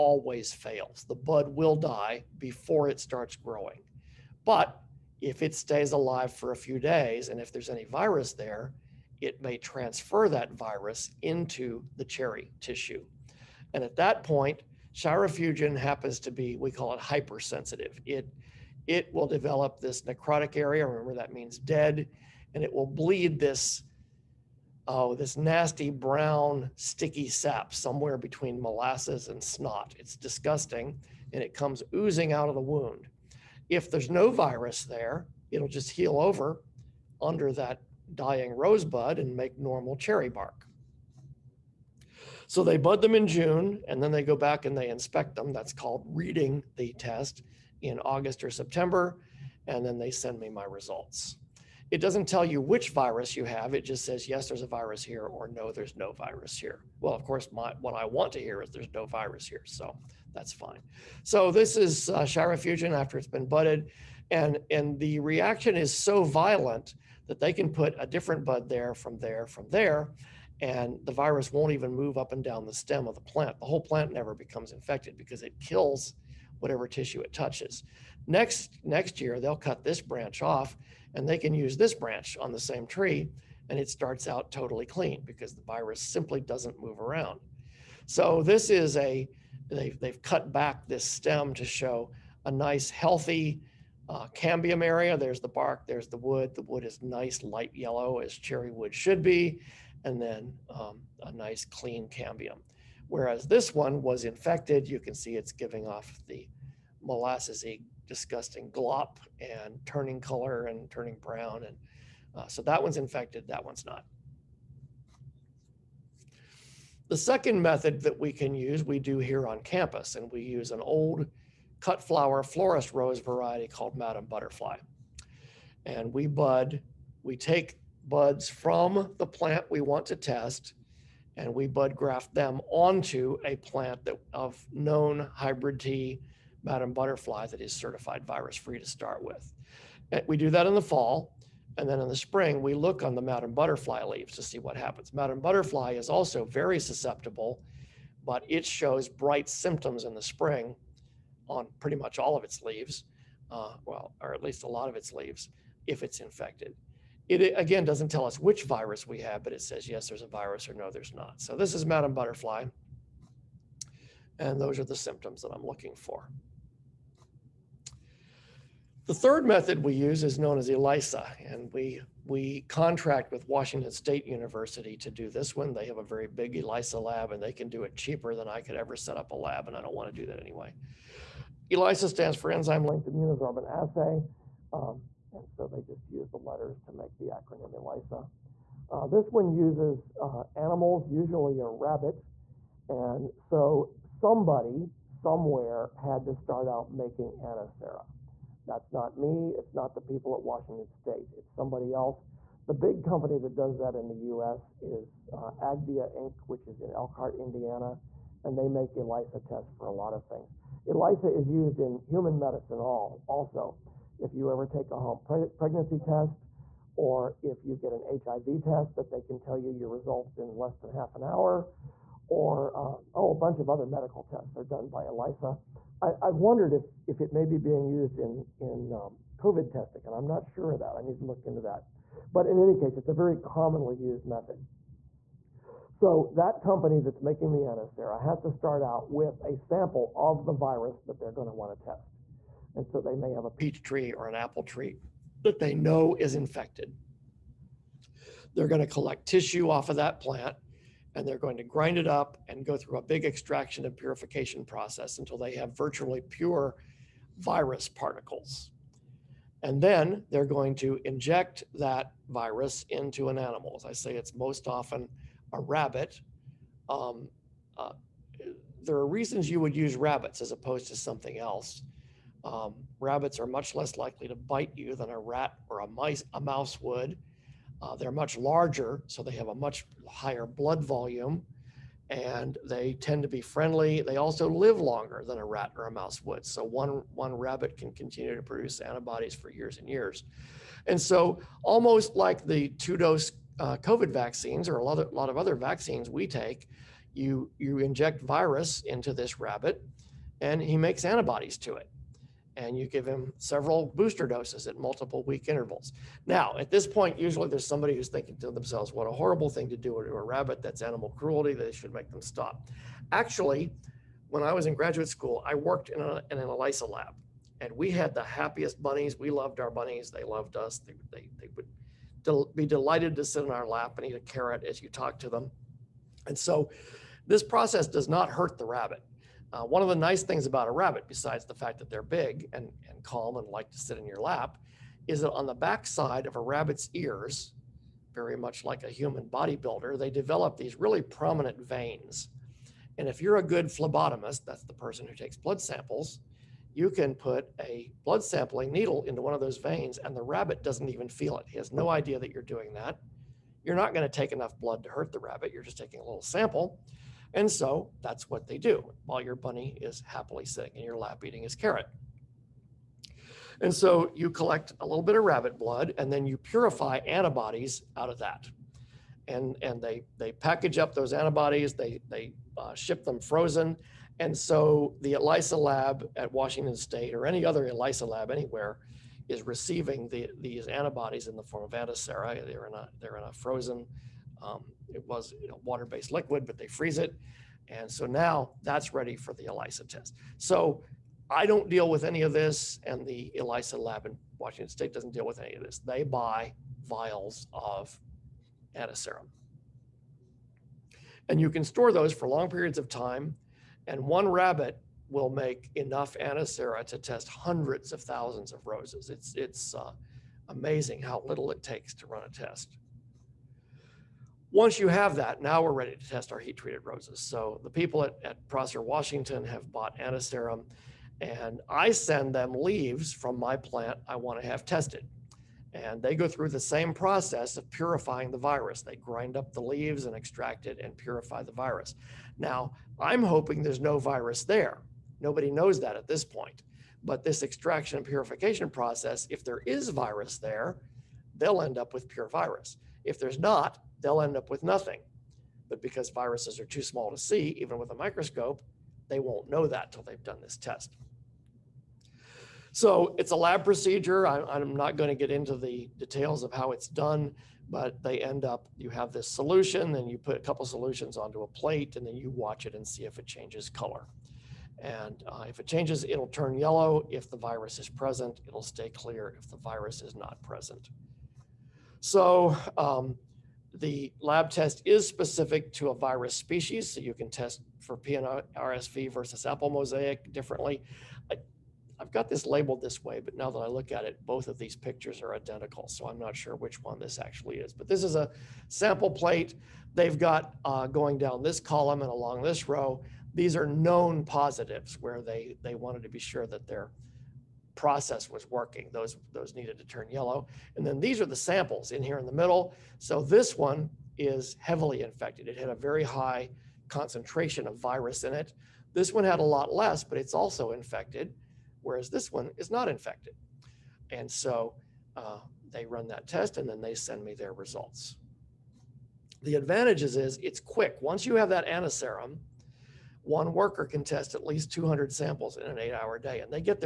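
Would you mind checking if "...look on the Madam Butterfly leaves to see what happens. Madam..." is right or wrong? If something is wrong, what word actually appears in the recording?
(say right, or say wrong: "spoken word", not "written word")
right.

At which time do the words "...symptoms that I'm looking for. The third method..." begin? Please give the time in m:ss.
2:44.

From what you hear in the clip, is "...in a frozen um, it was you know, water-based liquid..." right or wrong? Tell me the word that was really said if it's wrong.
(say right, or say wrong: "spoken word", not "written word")
right.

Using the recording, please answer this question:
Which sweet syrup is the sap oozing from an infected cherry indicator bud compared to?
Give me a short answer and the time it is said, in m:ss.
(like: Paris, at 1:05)
Molasses, at 0:28.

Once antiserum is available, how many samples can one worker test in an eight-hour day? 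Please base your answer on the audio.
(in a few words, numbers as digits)
At least 200.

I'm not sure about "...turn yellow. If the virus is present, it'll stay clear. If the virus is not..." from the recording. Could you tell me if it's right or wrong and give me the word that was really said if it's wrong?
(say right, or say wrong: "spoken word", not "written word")
right.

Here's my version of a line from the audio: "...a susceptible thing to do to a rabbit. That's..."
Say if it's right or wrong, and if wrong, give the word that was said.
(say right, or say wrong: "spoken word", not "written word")
wrong: "horrible", not "susceptible".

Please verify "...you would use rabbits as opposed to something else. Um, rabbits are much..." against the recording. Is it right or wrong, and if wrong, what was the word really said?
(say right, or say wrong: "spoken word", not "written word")
right.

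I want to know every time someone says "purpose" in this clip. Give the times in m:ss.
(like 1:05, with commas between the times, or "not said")
not said.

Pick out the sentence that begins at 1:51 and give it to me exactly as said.
And uh, so that one's infected, that one's not.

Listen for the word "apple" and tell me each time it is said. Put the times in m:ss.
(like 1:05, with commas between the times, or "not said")
4:04, 7:59.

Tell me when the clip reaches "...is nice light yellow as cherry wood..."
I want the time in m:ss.
1:36.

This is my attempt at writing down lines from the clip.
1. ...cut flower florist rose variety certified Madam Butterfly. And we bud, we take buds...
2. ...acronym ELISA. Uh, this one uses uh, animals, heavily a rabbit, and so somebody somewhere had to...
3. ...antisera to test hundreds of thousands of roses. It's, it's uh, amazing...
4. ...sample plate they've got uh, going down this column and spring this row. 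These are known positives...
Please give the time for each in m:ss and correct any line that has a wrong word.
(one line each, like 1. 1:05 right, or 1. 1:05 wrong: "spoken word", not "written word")
1. 2:01 wrong: "called", not "certified"
2. 3:07 wrong: "usually", not "heavily"
3. 6:46 right
4. 8:08 wrong: "along", not "spring".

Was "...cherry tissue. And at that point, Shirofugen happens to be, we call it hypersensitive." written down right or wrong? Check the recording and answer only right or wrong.
right.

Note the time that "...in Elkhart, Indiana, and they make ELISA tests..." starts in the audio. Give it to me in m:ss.
3:26.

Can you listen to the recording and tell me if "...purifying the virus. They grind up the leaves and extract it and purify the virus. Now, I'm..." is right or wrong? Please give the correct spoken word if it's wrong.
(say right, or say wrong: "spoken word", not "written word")
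right.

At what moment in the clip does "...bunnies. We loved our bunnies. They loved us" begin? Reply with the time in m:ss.
5:18.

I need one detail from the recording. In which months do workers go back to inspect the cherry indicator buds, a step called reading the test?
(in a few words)
August or September.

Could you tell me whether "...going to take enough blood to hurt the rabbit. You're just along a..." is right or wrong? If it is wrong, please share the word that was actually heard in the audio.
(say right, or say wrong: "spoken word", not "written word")
wrong: "taking", not "along".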